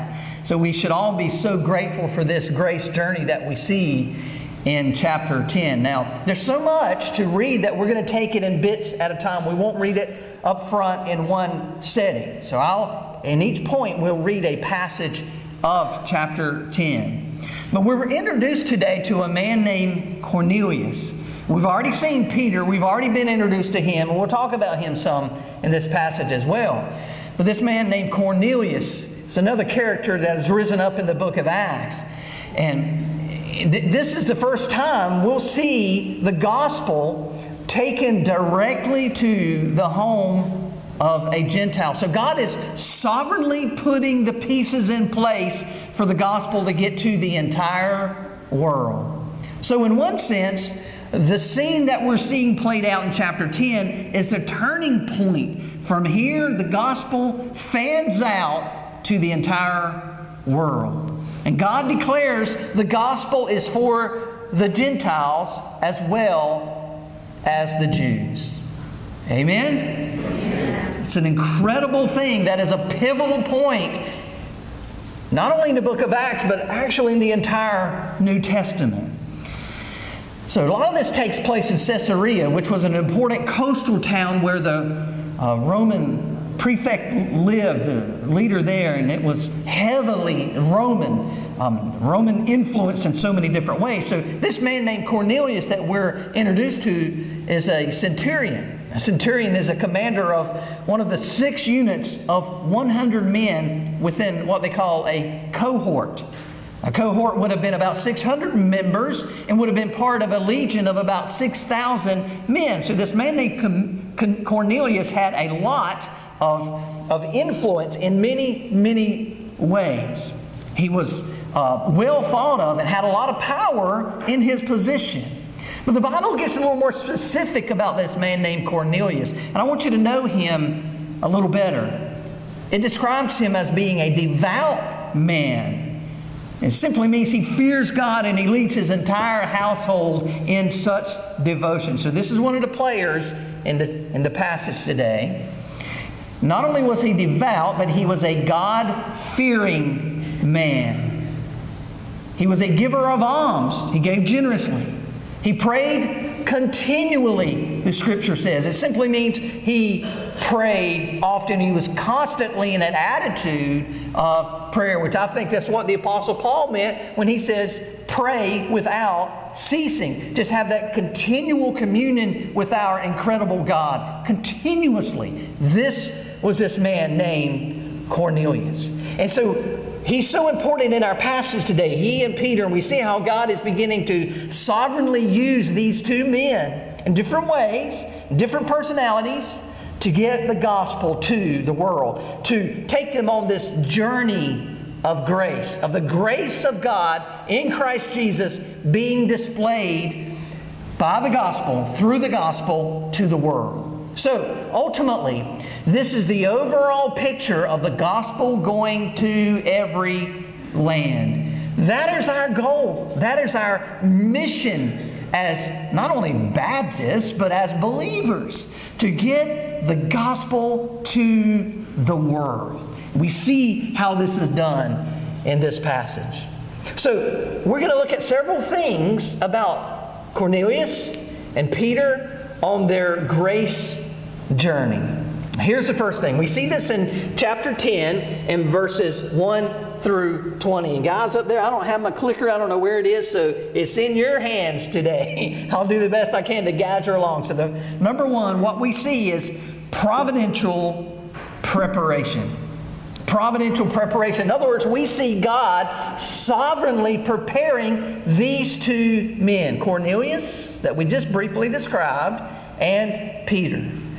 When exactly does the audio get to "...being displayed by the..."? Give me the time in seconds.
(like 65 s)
198 s.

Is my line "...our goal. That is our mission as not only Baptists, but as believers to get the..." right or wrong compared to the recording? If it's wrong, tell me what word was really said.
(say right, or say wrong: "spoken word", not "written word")
right.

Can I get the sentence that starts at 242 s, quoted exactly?
I don't know where it is, so it's in your hands today.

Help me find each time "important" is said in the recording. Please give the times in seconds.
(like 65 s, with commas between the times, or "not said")
82 s, 180 s.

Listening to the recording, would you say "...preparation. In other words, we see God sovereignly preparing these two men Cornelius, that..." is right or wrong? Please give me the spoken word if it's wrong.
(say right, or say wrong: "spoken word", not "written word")
right.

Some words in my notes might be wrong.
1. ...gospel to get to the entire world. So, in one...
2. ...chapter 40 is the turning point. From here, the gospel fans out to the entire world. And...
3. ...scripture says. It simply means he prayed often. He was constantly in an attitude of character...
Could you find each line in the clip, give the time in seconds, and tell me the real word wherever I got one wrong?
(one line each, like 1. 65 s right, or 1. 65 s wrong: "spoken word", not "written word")
1. 46 s right
2. 53 s wrong: "10", not "40"
3. 157 s wrong: "prayer", not "character".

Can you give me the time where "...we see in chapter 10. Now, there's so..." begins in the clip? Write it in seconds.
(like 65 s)
3 s.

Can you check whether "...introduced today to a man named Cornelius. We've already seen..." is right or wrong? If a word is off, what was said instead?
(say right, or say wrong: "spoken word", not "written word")
right.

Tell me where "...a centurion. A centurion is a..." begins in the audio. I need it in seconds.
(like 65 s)
97 s.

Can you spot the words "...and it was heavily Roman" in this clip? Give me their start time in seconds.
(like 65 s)
88 s.